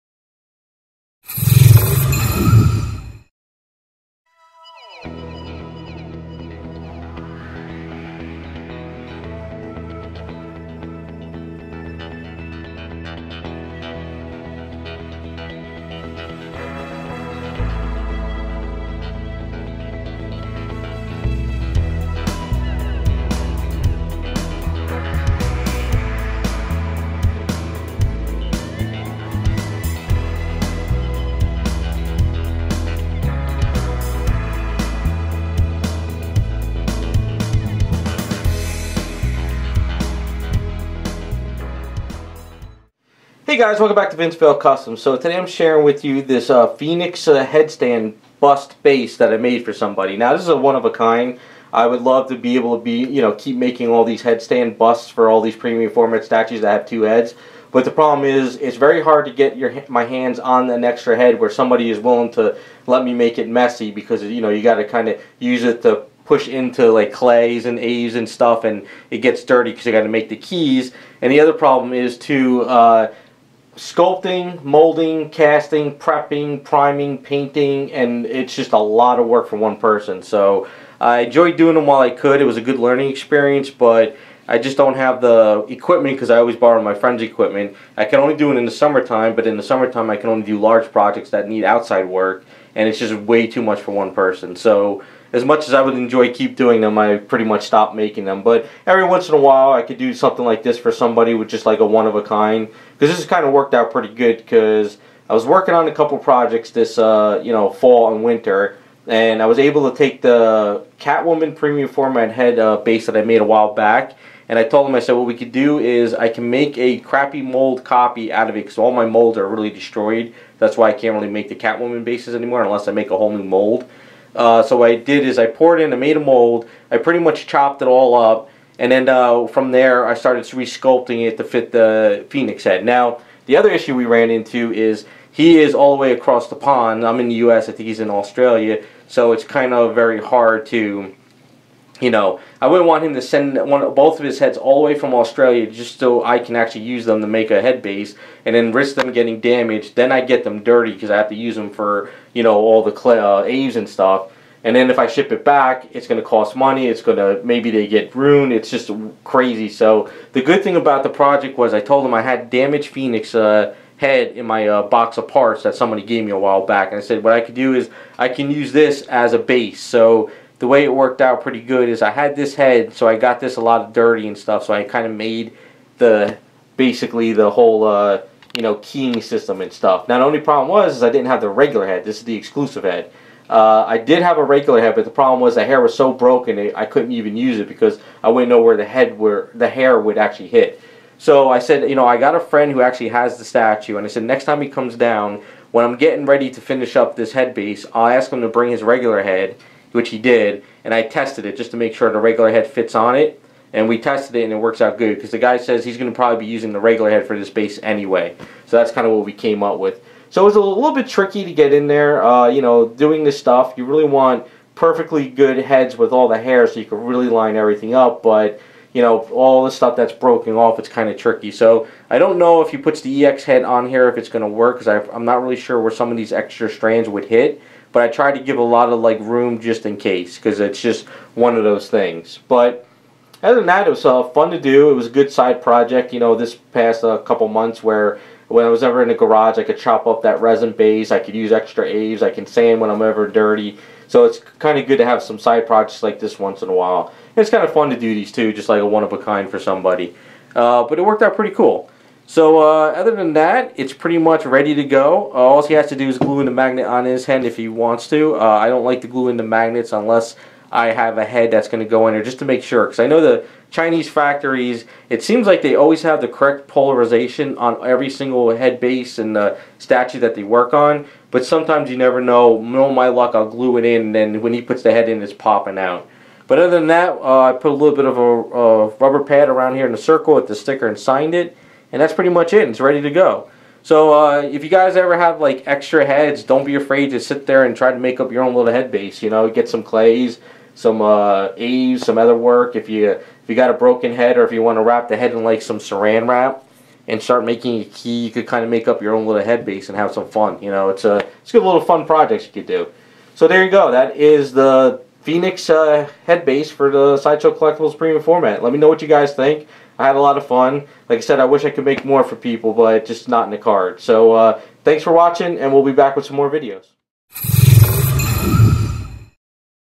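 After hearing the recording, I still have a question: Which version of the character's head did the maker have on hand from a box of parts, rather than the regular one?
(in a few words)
The exclusive head.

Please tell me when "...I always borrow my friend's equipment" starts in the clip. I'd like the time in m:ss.
1:26.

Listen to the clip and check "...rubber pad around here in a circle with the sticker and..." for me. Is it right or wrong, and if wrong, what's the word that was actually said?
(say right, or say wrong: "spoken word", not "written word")
right.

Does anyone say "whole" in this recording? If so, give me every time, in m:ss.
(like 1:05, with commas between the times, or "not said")
2:03, 2:57.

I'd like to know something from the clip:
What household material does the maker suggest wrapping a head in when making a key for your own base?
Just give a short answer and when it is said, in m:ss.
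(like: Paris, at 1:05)
Saran wrap, at 4:55.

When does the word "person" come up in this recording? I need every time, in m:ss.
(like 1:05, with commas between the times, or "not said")
1:19, 1:34.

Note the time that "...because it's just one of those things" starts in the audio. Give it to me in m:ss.
3:50.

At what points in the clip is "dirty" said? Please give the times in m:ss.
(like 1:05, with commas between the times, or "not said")
1:09, 2:30, 2:53, 4:03.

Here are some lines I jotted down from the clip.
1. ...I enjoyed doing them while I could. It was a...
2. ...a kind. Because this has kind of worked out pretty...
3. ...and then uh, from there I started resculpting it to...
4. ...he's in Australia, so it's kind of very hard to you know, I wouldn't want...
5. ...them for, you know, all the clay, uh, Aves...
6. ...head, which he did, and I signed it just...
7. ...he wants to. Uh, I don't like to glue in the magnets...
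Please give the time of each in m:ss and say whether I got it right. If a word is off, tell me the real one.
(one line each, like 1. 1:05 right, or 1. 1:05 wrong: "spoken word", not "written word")
1. 1:20 right
2. 1:42 right
3. 2:08 right
4. 2:17 right
5. 2:31 right
6. 3:19 wrong: "tested", not "signed"
7. 4:17 right.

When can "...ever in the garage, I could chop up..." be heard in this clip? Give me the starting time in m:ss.
3:58.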